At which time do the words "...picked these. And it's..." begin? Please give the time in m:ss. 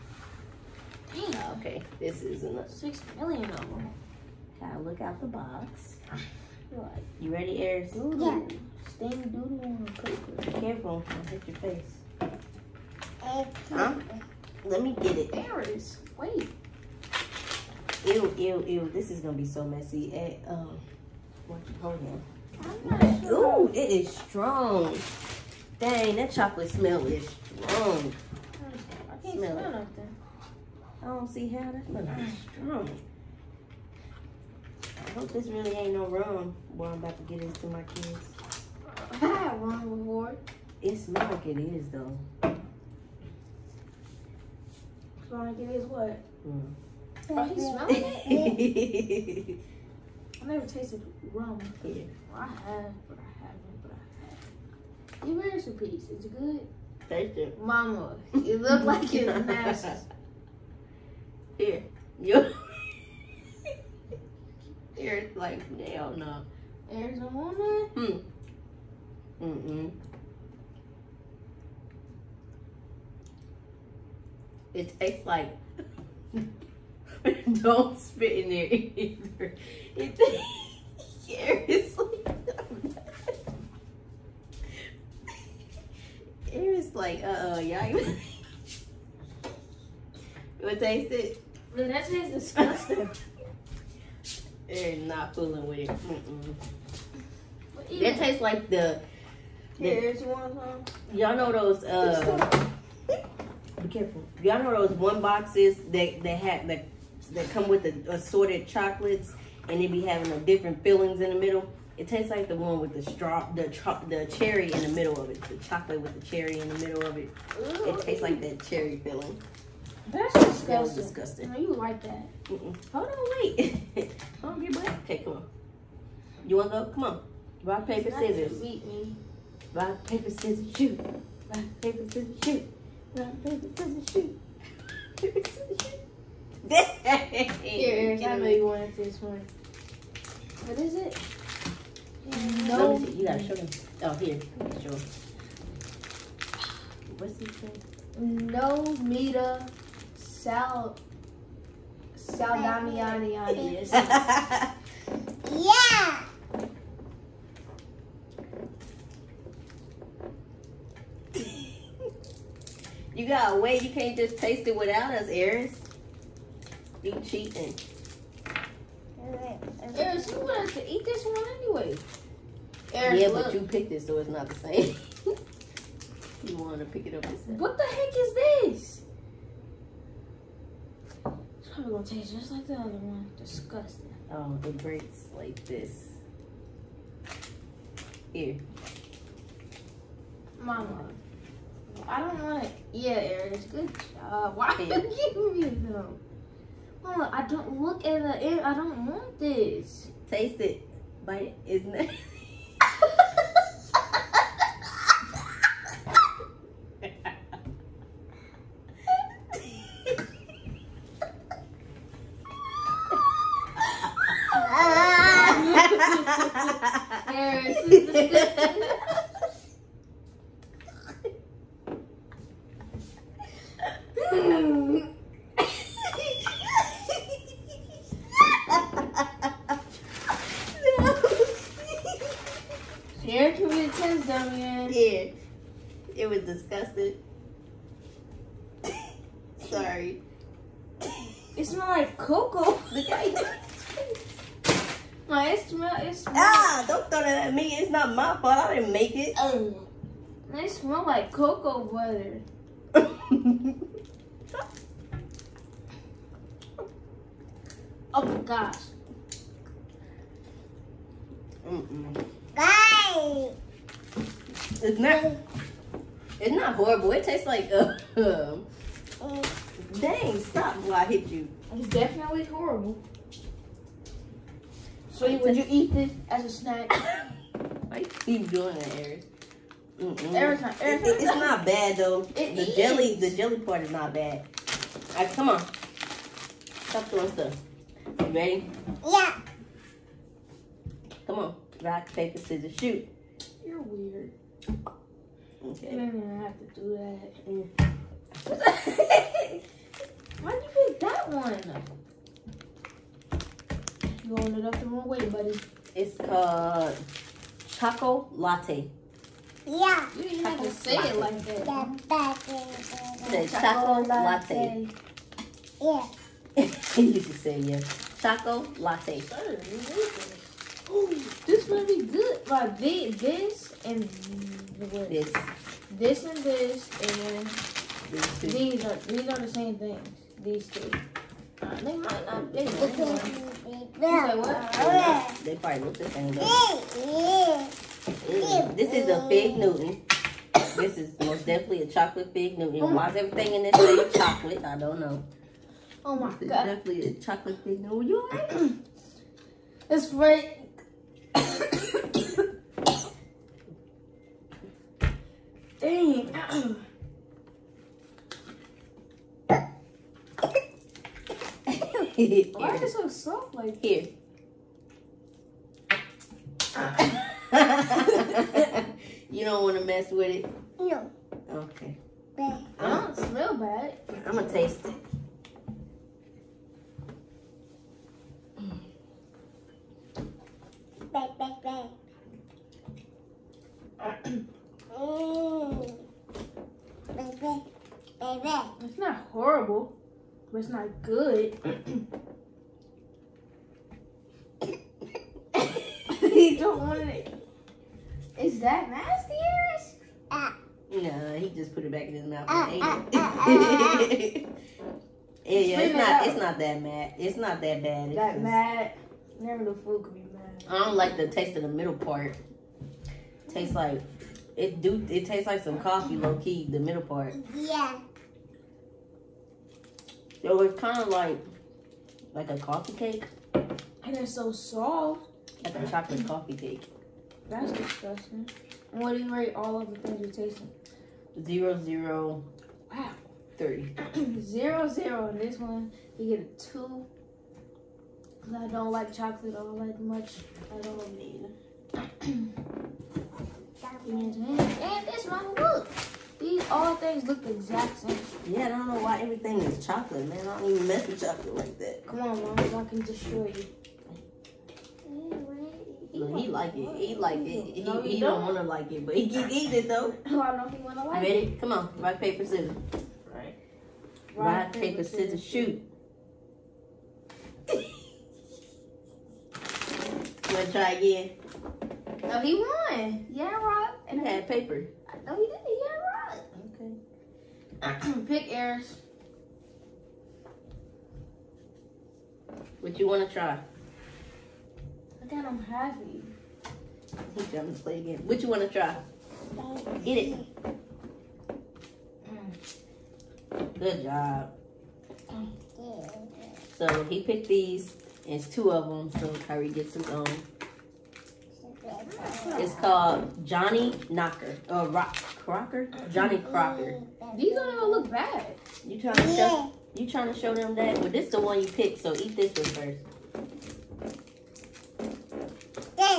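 8:17.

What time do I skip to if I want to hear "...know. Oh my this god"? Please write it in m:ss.
5:45.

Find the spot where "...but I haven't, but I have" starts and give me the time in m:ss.
0:53.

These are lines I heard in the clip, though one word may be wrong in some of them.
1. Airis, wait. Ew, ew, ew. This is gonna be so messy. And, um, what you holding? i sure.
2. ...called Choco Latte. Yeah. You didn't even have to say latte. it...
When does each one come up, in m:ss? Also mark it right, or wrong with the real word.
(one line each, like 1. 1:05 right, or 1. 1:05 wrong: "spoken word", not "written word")
1. 0:15 right
2. 5:06 right.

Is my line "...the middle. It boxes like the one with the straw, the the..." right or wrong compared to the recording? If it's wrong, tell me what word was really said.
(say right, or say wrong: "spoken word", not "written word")
wrong: "tastes", not "boxes".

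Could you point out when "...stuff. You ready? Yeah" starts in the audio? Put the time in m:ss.
4:47.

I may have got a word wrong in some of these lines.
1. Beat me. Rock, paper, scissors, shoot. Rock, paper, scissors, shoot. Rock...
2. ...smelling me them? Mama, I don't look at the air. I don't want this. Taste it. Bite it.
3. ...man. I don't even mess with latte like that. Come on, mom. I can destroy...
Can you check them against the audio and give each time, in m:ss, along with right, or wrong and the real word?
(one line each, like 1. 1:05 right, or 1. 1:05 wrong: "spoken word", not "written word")
1. 2:08 right
2. 3:15 wrong: "giving", not "smelling"
3. 7:30 wrong: "chocolate", not "latte".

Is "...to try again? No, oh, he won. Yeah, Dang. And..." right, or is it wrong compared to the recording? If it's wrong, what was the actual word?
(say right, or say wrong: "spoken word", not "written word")
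wrong: "Rock", not "Dang".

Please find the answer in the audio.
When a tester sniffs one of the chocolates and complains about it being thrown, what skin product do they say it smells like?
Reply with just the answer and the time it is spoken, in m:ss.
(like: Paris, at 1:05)
cocoa butter, at 4:10.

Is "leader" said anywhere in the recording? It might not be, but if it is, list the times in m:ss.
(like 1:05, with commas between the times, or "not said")
not said.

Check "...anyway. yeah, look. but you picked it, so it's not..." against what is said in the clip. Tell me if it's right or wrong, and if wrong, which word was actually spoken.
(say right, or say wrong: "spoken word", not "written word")
right.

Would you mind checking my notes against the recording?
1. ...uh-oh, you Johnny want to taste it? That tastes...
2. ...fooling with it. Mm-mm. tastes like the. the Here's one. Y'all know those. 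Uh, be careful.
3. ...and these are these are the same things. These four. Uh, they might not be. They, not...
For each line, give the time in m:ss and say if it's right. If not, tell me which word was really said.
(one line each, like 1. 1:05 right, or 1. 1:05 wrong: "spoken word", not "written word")
1. 1:27 wrong: "You", not "Johnny"
2. 1:35 right
3. 5:27 wrong: "two", not "four".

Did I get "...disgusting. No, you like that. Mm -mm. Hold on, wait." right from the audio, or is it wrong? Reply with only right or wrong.
right.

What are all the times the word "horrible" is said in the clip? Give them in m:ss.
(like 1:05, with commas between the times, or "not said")
4:26, 4:32, 6:29.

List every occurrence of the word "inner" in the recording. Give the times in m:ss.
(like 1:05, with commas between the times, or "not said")
not said.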